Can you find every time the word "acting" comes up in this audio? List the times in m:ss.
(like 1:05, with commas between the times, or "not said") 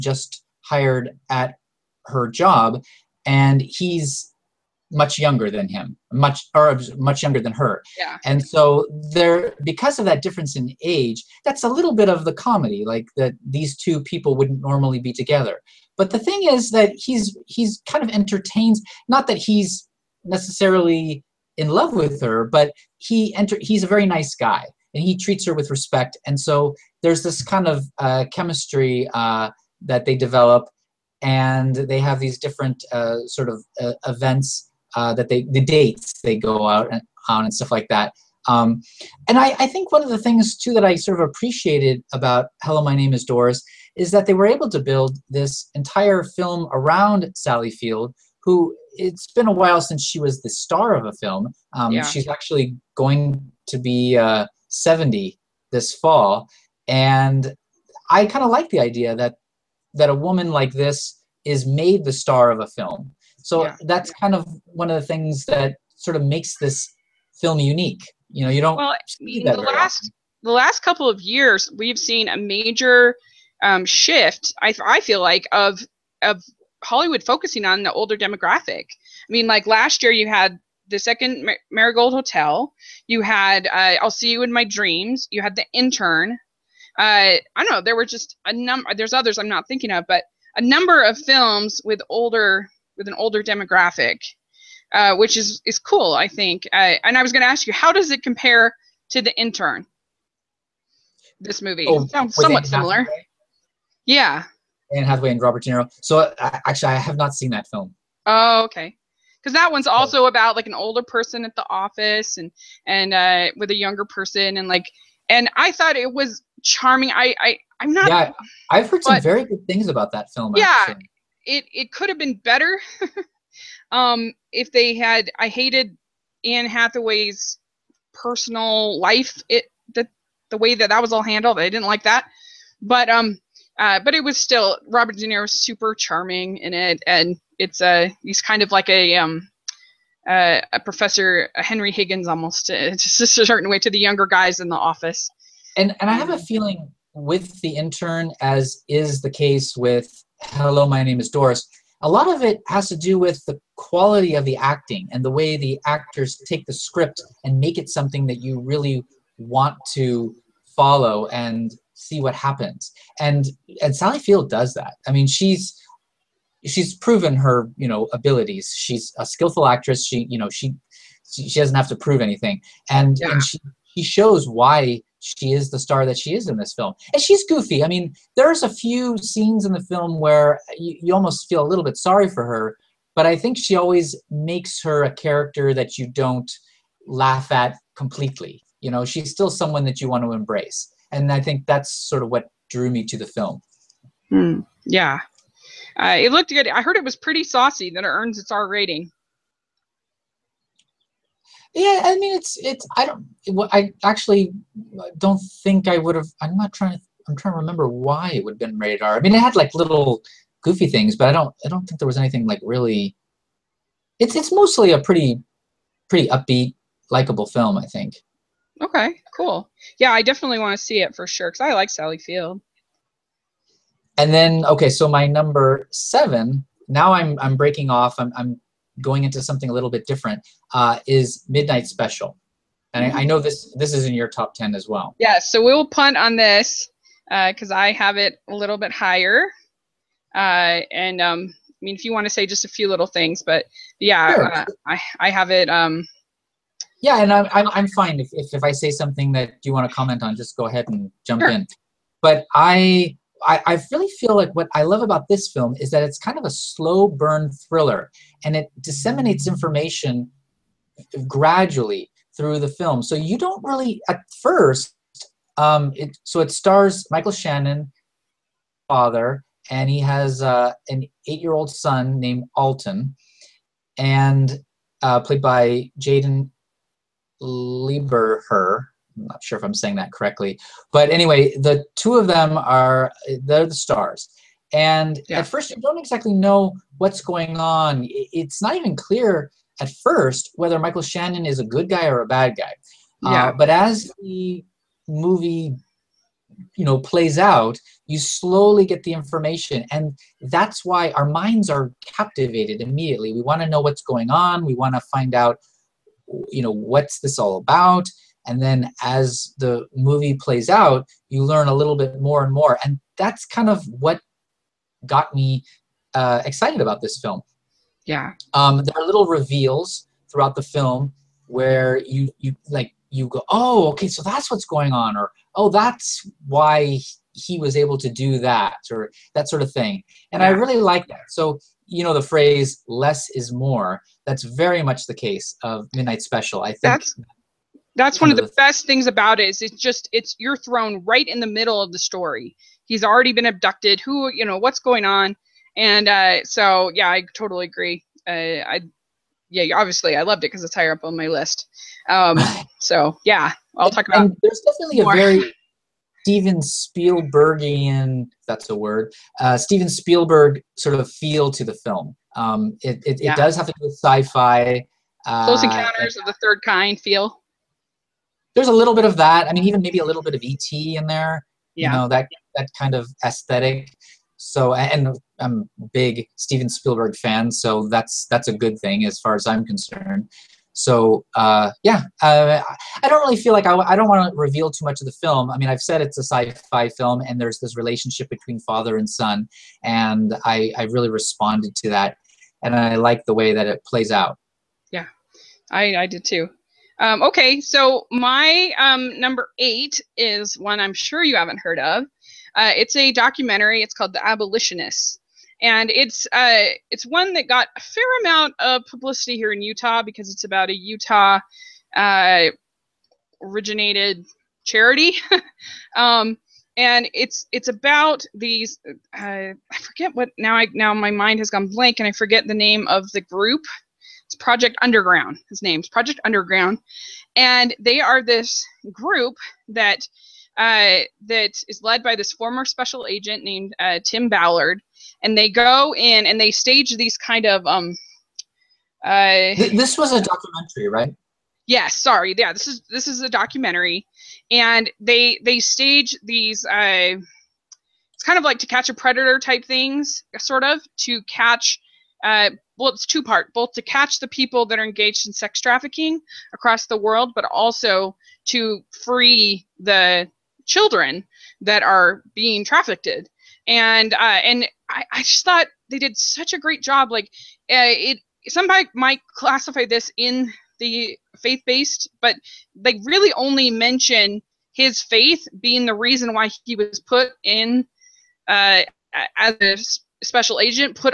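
2:34.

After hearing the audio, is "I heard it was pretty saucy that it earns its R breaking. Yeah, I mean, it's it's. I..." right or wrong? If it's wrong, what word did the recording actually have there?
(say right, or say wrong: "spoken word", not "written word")
wrong: "rating", not "breaking".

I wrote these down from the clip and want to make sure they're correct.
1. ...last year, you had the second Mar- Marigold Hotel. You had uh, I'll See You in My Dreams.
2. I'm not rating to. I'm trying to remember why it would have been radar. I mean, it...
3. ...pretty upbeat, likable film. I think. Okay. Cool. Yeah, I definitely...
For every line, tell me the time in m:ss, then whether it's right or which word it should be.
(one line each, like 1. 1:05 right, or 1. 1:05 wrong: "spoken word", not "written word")
1. 1:19 right
2. 3:26 wrong: "trying", not "rating"
3. 3:36 right.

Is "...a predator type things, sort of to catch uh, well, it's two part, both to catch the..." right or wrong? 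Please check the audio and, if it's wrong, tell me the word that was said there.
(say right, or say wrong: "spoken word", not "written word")
right.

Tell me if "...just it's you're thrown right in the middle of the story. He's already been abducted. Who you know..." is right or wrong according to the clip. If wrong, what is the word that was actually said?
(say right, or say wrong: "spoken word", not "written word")
right.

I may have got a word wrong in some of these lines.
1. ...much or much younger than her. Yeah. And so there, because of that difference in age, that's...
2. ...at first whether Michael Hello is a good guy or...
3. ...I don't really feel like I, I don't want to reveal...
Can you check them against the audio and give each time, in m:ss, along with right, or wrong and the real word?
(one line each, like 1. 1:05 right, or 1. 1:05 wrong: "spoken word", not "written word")
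1. 0:06 right
2. 4:49 wrong: "Shannon", not "Hello"
3. 6:23 right.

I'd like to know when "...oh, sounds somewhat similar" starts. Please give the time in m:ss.
1:41.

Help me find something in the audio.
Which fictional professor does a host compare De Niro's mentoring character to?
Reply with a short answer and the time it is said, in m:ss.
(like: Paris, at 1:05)
Henry Higgins, at 2:21.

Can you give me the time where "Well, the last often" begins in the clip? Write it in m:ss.
1:08.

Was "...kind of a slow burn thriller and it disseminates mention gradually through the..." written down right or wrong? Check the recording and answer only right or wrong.
wrong.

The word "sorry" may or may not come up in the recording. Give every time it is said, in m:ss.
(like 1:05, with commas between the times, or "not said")
3:01, 7:21.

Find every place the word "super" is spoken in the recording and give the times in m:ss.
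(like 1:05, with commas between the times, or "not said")
2:15.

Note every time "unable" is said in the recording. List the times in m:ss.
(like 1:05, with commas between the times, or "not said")
not said.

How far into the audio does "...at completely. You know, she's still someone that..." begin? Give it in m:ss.
3:07.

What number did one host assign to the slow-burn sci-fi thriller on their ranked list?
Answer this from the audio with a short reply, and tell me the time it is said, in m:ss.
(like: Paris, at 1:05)
7, at 3:45.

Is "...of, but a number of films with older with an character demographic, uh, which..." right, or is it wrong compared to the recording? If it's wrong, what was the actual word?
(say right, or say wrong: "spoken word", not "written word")
wrong: "older", not "character".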